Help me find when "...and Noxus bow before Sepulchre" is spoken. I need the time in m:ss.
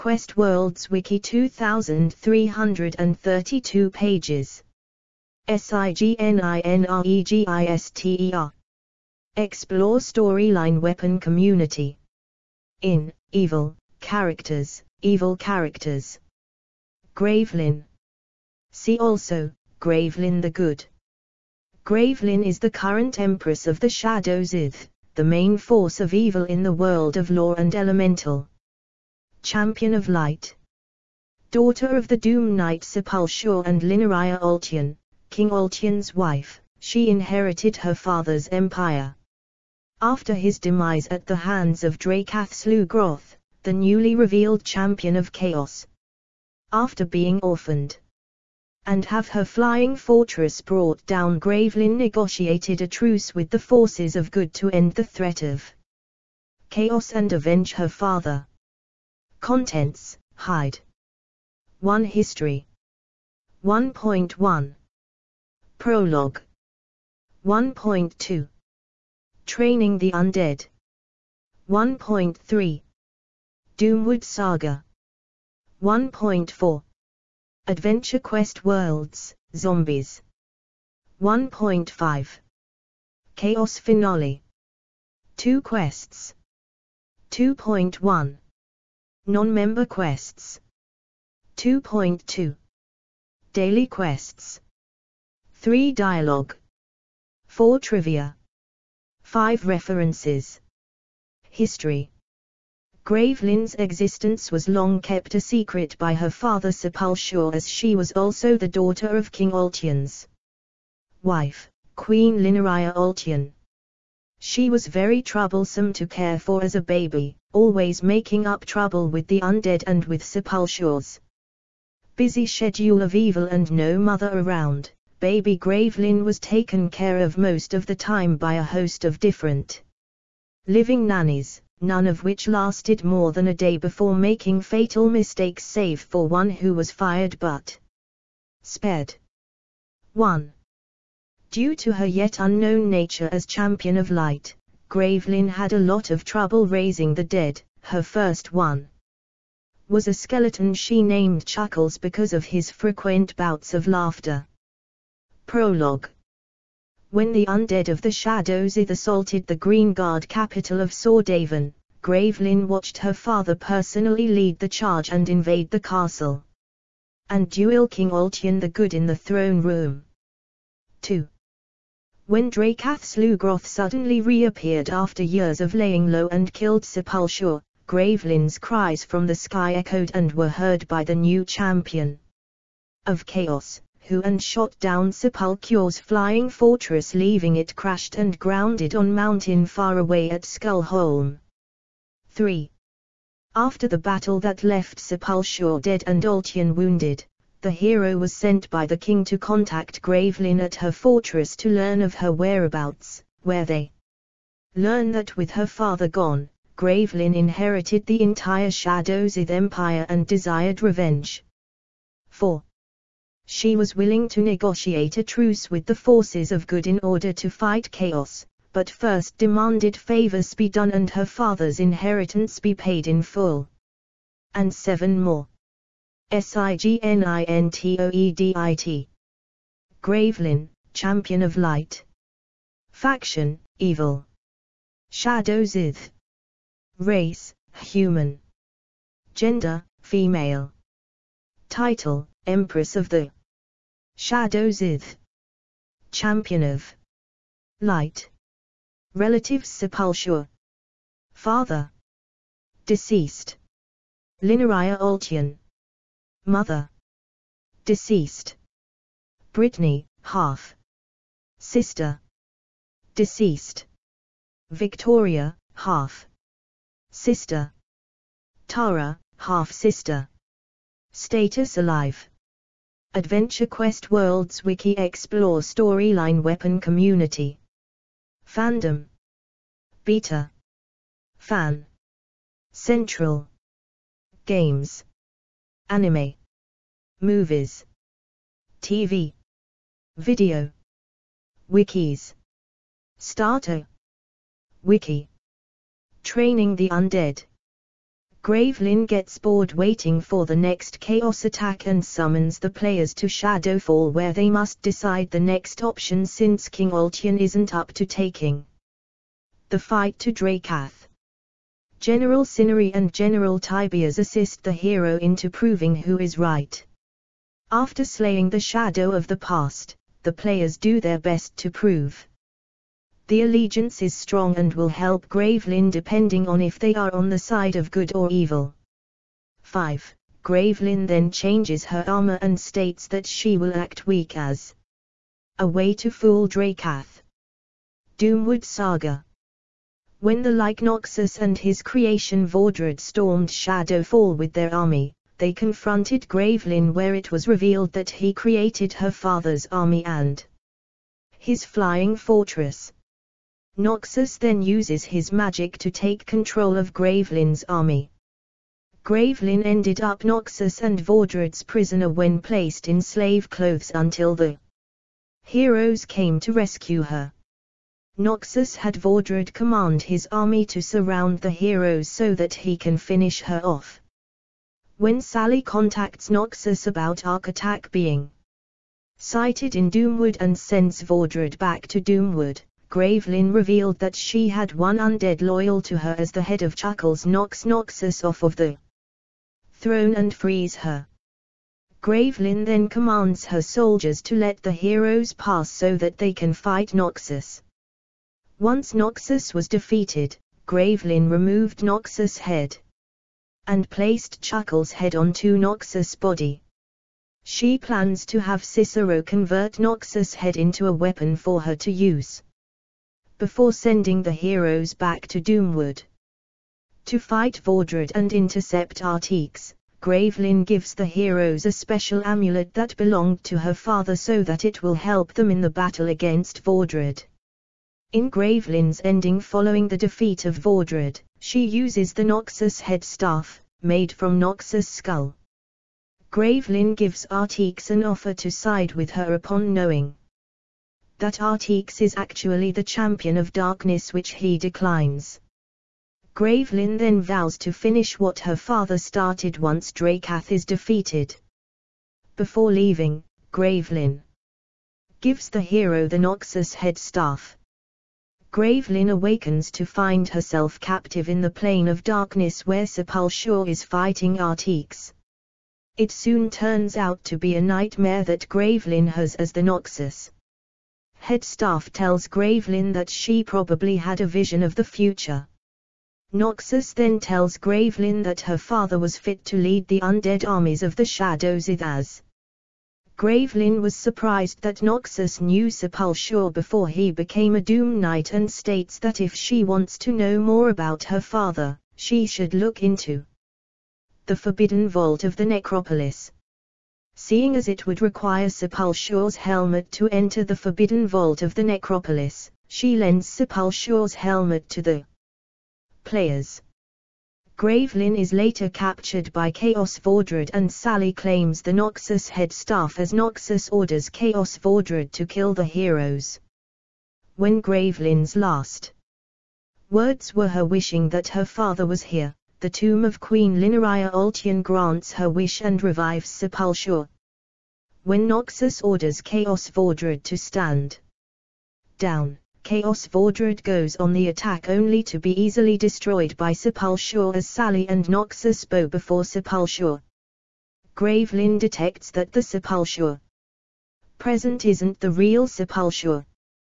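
8:57.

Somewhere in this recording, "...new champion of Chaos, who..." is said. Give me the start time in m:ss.
3:01.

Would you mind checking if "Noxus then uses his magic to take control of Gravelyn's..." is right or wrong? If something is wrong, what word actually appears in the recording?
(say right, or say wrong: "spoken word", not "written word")
right.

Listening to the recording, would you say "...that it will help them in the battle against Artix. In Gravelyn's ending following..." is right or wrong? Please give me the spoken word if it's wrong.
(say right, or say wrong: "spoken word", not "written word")
wrong: "Vordred", not "Artix".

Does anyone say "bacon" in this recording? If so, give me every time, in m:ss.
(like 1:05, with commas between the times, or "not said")
not said.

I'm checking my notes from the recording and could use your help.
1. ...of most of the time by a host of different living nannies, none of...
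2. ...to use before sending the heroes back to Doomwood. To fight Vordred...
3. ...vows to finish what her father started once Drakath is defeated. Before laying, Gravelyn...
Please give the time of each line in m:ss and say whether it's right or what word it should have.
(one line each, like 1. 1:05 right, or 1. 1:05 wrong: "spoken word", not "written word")
1. 2:07 right
2. 6:51 right
3. 7:27 wrong: "leaving", not "laying".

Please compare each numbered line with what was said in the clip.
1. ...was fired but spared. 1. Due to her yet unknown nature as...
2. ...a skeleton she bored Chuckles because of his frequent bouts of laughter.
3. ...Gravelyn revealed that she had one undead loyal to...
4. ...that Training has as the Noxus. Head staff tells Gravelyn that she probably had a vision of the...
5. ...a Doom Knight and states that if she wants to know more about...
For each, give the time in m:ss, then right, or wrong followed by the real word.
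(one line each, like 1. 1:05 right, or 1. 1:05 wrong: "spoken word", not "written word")
1. 2:16 right
2. 2:30 wrong: "named", not "bored"
3. 6:22 right
4. 7:48 wrong: "Gravelyn", not "Training"
5. 8:07 right.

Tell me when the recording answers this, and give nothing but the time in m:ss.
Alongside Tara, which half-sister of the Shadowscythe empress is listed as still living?
4:24.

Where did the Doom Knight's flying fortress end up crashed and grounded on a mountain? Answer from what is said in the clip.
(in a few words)
Skullholm.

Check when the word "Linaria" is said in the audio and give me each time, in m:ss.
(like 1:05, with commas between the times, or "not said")
0:33, 1:52, 4:14, 8:43.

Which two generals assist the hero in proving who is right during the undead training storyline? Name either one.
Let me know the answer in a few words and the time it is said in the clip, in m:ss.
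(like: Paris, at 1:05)
General Cinnery, at 5:11.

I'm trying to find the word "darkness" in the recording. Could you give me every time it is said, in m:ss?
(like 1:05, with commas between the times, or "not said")
7:23, 7:42.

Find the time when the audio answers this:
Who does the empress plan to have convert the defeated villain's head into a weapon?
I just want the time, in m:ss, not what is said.
6:48.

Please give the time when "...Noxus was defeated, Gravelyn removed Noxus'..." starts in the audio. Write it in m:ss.
6:38.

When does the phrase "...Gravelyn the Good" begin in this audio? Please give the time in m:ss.
0:19.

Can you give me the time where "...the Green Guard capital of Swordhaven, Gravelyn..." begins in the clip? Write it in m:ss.
2:39.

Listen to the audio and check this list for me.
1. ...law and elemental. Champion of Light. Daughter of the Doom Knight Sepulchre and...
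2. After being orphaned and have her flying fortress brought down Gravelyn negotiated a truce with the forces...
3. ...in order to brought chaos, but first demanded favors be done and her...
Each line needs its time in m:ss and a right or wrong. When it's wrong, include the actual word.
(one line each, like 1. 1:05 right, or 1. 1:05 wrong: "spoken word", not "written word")
1. 0:27 right
2. 0:46 right
3. 3:36 wrong: "fight", not "brought".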